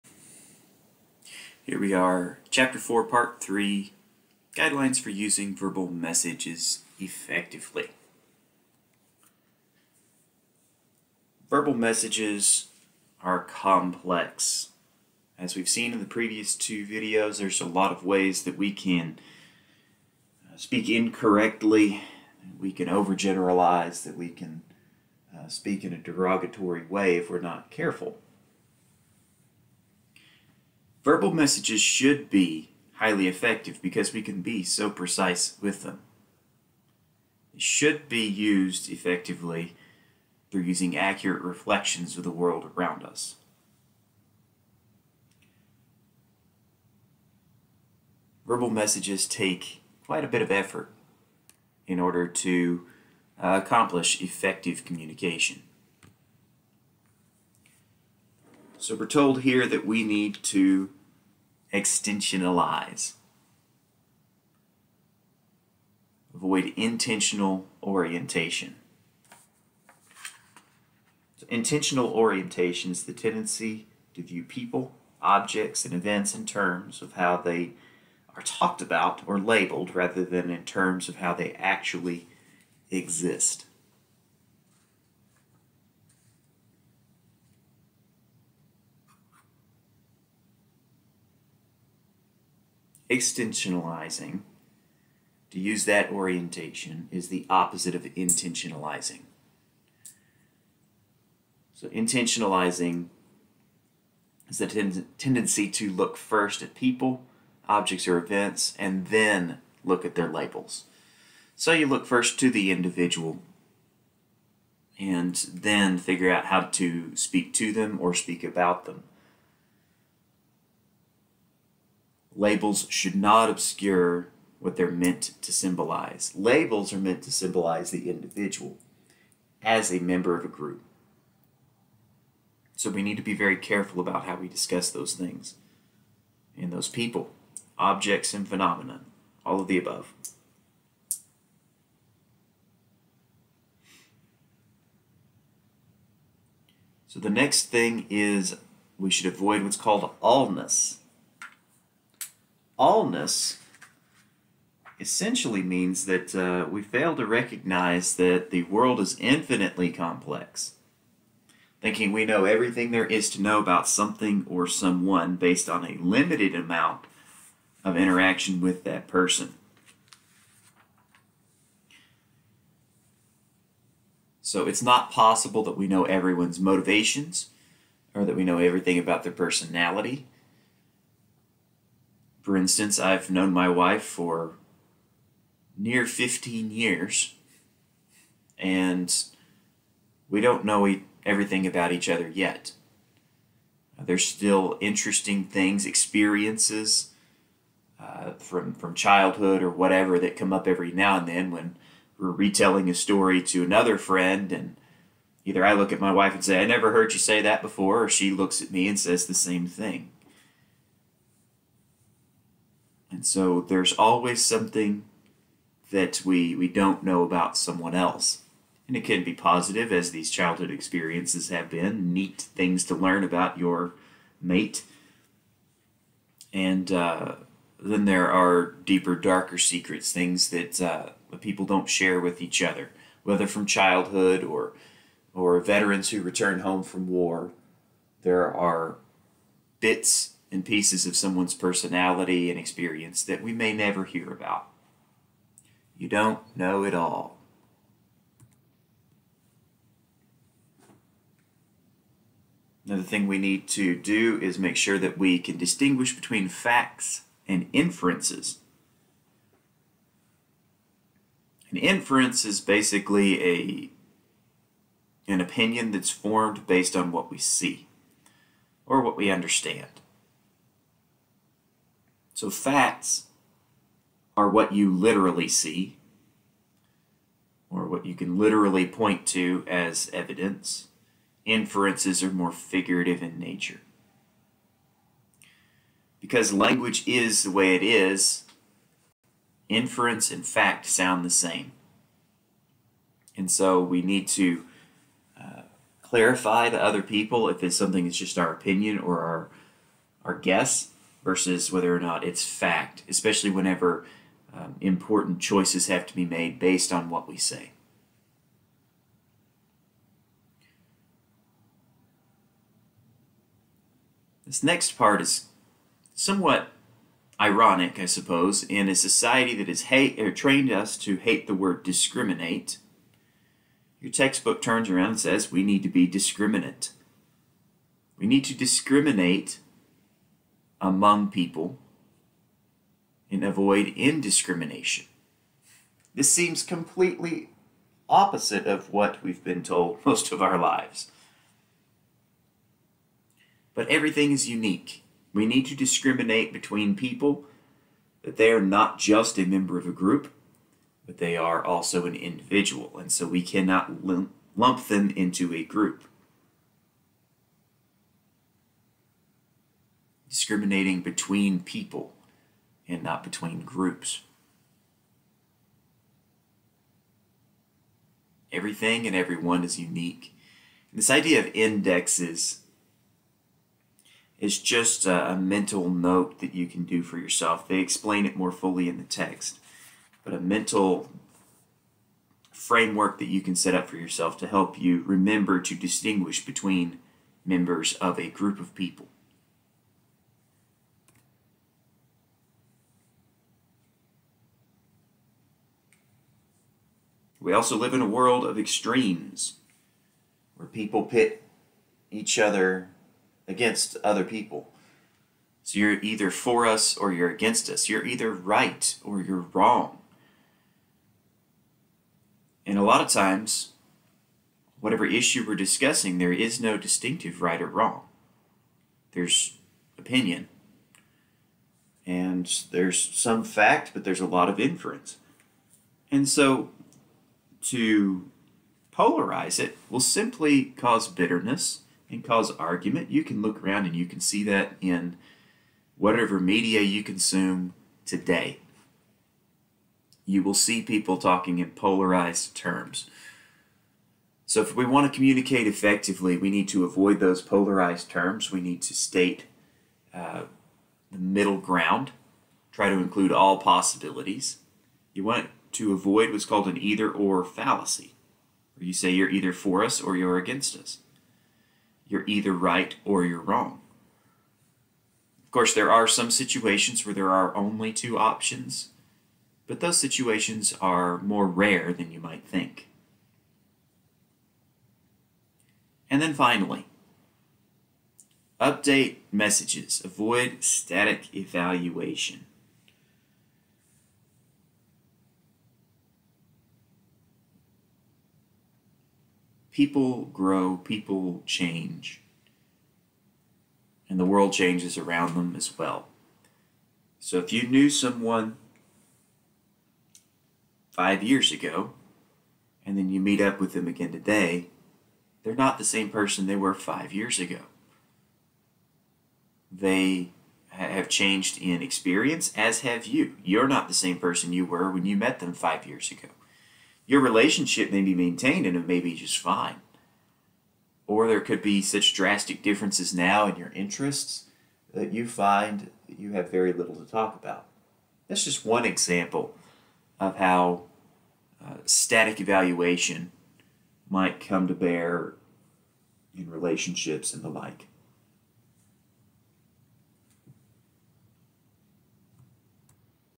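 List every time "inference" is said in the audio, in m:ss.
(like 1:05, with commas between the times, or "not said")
4:17, 4:21, 4:41, 4:49, 7:04.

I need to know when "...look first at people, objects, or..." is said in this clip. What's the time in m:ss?
1:45.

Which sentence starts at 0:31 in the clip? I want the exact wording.
Verbal messages should be highly effective because we can be so precise with them.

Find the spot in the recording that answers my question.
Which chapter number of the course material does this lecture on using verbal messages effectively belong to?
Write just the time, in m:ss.
0:02.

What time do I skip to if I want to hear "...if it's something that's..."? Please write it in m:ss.
4:57.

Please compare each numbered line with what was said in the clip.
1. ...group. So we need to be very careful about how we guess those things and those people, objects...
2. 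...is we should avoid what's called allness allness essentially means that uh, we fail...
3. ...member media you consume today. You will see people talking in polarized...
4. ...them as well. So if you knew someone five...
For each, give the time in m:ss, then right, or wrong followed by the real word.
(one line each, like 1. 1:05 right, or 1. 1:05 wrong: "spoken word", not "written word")
1. 2:10 wrong: "discuss", not "guess"
2. 2:28 right
3. 7:15 wrong: "whatever", not "member"
4. 8:15 right.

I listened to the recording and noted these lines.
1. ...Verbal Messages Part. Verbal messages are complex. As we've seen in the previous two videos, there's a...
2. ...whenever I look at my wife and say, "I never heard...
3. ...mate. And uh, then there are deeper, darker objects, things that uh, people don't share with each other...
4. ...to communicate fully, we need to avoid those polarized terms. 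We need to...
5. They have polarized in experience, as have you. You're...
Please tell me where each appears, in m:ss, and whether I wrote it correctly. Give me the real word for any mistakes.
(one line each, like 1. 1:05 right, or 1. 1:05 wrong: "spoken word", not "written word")
1. 0:05 wrong: "Effectively", not "Part"
2. 3:25 wrong: "either", not "whenever"
3. 3:44 wrong: "secrets", not "objects"
4. 7:25 wrong: "effectively", not "fully"
5. 8:29 wrong: "changed", not "polarized".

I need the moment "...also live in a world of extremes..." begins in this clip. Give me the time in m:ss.
6:37.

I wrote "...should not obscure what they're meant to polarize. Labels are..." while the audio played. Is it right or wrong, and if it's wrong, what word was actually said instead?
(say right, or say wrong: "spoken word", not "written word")
wrong: "symbolize", not "polarize".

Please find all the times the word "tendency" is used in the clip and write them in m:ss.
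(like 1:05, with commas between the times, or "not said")
1:13, 1:45.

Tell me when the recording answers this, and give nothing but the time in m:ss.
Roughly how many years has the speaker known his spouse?
3:06.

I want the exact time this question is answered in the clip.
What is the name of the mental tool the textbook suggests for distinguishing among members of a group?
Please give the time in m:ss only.
6:11.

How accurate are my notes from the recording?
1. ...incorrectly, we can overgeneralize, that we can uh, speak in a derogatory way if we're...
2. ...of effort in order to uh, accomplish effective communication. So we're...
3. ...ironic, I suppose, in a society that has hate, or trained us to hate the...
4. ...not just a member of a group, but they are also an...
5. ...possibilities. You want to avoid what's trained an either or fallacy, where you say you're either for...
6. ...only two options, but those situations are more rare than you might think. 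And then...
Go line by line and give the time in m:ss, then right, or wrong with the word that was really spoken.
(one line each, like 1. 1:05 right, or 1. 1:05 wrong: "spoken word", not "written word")
1. 0:20 right
2. 0:50 right
3. 5:17 right
4. 5:48 right
5. 7:33 wrong: "called", not "trained"
6. 7:47 right.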